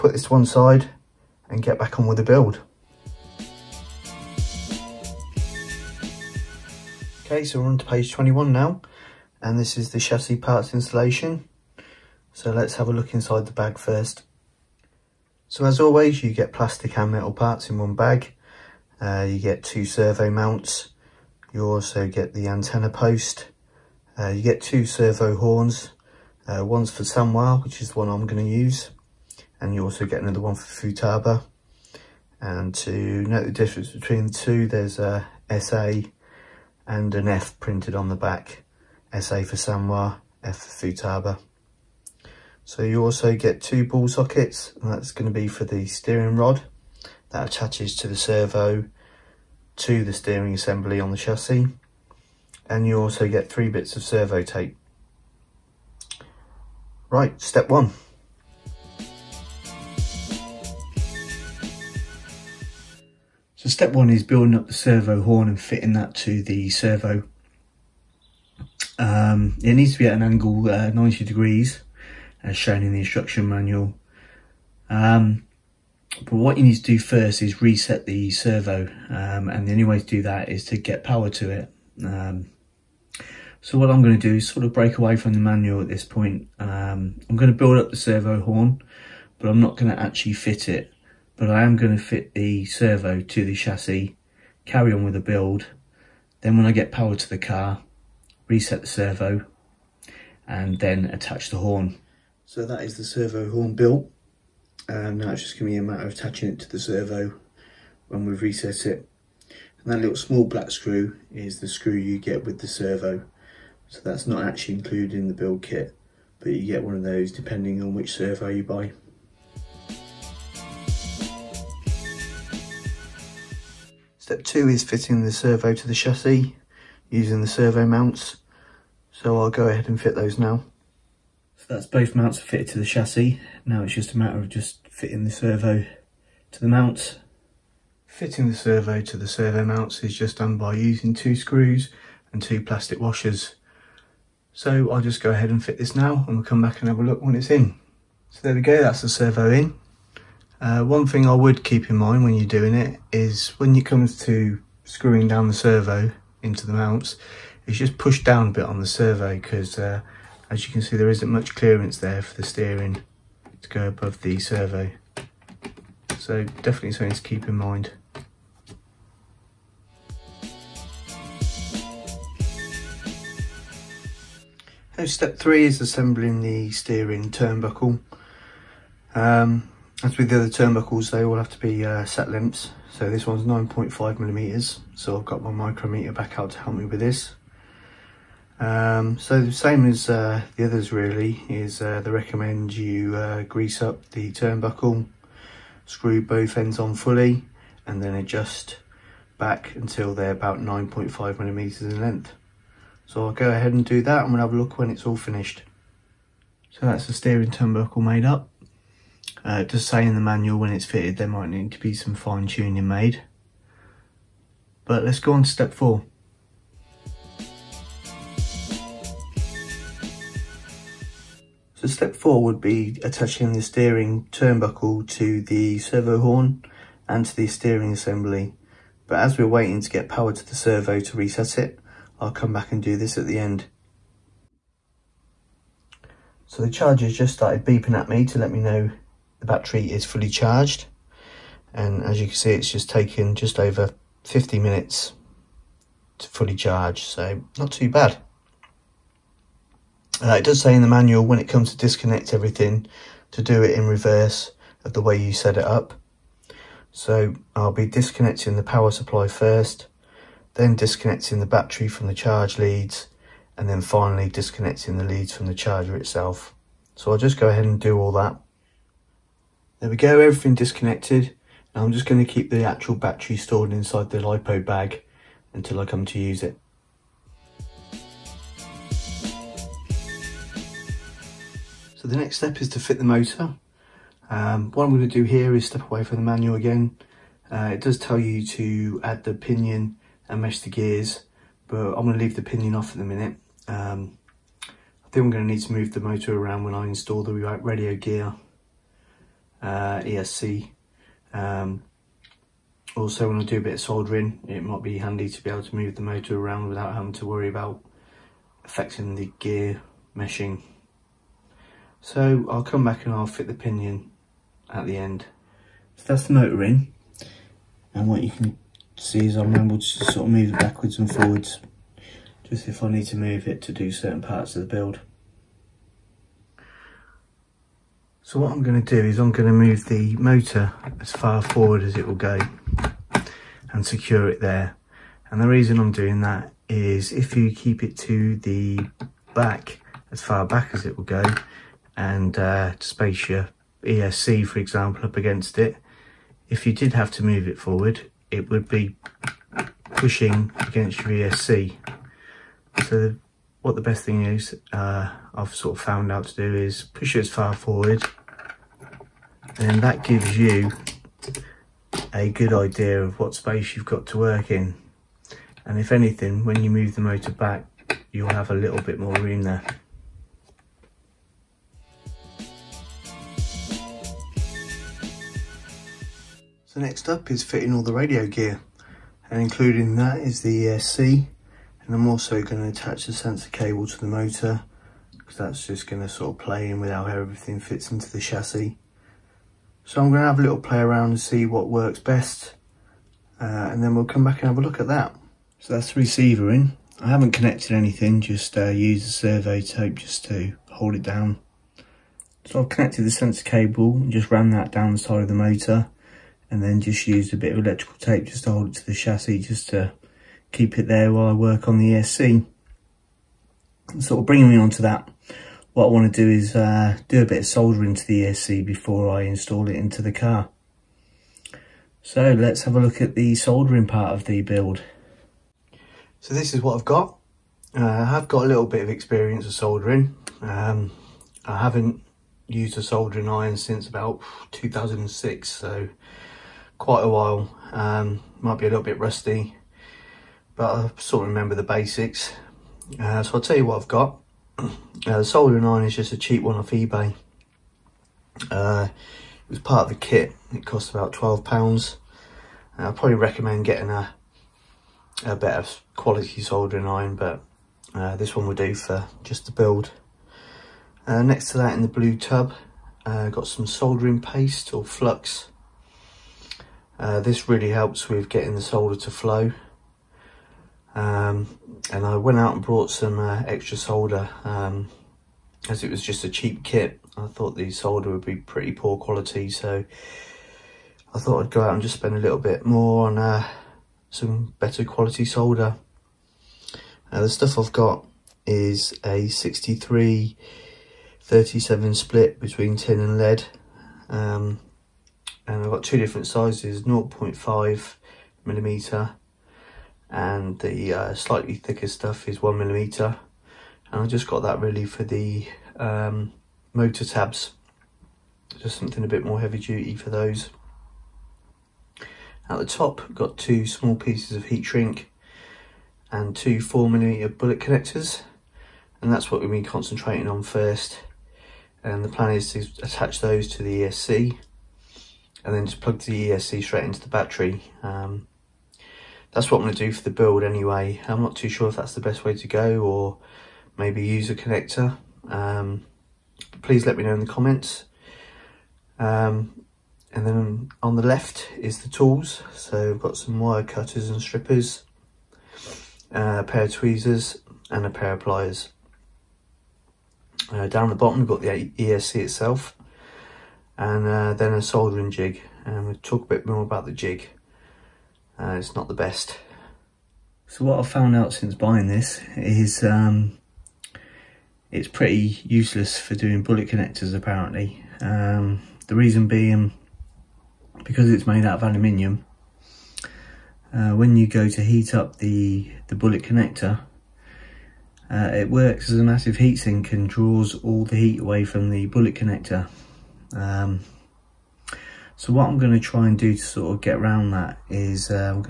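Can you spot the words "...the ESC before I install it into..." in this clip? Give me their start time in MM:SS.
06:58.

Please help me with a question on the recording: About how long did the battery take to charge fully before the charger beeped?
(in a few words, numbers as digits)
just over 50 minutes.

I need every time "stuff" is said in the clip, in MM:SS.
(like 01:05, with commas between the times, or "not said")
08:07, 08:21.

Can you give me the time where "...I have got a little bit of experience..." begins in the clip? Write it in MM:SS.
07:07.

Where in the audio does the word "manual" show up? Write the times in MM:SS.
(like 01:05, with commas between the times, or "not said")
01:13, 01:25, 03:30, 04:10, 04:46.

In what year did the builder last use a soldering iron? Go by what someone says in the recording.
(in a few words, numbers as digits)
2006.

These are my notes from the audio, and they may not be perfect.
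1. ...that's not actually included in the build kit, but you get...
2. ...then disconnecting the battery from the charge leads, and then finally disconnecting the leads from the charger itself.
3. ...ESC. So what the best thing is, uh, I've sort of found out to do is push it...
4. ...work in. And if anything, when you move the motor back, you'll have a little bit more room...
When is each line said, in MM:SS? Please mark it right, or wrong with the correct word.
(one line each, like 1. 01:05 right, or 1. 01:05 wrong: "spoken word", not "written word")
1. 01:54 right
2. 04:20 right
3. 05:51 right
4. 06:04 right.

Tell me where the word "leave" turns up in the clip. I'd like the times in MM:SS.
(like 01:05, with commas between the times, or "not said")
04:52.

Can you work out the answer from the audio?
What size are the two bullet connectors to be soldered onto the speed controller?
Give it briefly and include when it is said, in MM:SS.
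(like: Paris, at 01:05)
4 millimeter, at 08:36.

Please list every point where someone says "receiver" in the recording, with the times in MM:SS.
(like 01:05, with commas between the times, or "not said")
06:36.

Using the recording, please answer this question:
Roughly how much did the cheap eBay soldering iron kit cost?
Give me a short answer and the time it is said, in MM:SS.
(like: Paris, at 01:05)
£12, at 07:31.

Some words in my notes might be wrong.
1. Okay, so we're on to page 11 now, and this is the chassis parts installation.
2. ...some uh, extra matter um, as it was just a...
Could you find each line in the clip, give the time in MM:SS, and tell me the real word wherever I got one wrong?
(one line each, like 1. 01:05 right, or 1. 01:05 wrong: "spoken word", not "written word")
1. 00:07 wrong: "21", not "11"
2. 07:52 wrong: "solder", not "matter".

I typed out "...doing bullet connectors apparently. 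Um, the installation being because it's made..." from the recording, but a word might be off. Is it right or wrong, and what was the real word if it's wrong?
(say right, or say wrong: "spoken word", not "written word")
wrong: "reason", not "installation".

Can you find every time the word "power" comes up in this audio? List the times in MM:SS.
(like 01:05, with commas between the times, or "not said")
01:21, 01:36, 03:50, 04:18.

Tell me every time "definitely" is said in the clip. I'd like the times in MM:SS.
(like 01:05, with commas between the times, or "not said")
02:46.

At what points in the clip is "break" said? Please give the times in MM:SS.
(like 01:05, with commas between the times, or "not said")
01:24.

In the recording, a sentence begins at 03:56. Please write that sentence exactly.
So the charger just started beeping at me to let me know the battery is fully charged.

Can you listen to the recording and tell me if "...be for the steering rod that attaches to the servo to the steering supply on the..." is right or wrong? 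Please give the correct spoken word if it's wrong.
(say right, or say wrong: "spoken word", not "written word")
wrong: "assembly", not "supply".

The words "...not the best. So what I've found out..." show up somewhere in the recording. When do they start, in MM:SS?
09:18.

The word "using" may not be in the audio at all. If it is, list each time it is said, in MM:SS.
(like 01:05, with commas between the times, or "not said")
02:07, 02:20.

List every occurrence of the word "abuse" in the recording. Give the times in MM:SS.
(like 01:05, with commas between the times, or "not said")
not said.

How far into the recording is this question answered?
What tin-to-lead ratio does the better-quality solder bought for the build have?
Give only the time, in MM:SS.
08:09.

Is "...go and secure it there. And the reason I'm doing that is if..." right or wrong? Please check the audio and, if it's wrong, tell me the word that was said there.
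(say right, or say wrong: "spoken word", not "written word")
right.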